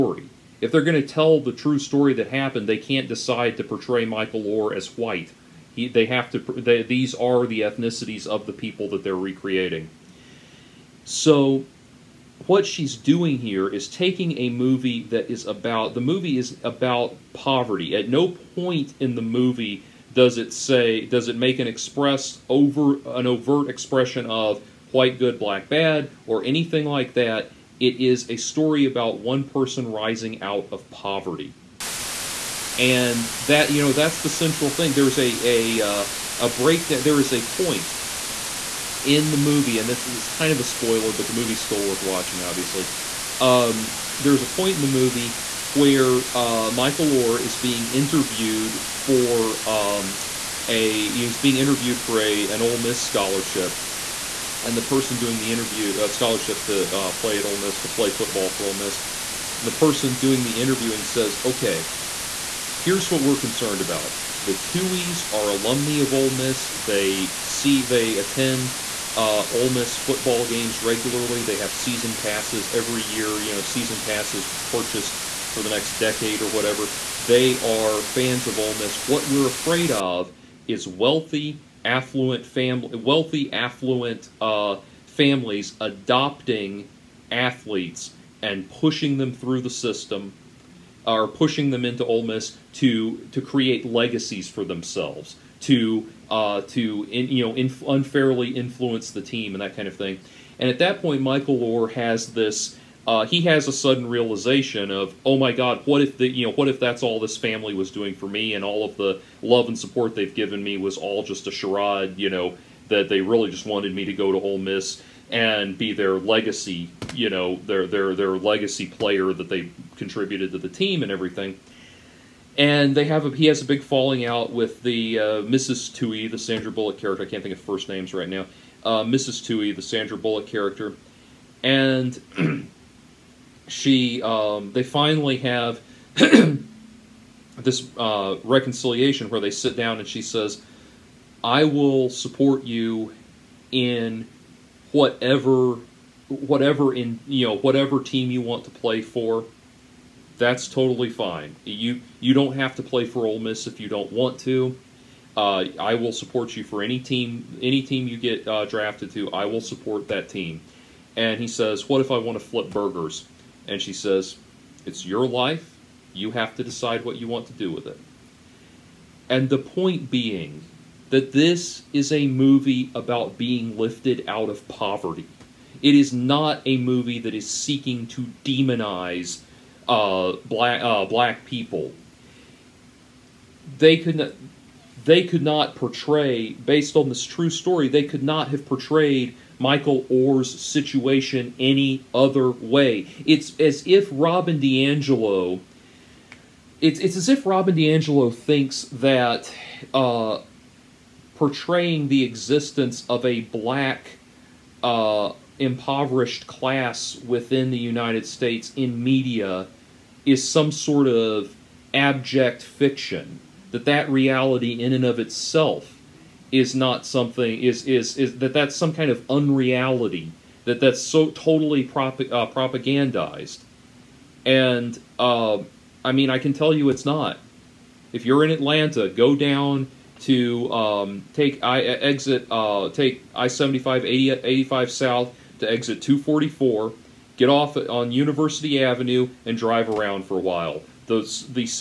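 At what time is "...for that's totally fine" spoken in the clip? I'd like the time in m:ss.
2:29.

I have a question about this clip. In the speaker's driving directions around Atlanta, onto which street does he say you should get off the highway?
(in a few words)
University Avenue.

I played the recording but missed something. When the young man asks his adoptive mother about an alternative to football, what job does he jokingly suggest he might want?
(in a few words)
Flip burgers.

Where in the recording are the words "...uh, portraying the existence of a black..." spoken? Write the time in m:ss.
3:19.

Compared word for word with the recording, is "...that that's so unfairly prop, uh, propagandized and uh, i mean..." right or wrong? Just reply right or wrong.
wrong.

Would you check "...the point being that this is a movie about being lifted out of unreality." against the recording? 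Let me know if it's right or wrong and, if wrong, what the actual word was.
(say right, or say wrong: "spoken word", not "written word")
wrong: "poverty", not "unreality".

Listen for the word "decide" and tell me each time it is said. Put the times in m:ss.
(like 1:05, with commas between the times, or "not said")
0:03, 2:46.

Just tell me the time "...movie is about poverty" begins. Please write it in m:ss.
0:16.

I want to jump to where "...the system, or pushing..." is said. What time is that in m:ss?
1:29.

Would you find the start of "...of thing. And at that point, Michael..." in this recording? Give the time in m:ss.
1:39.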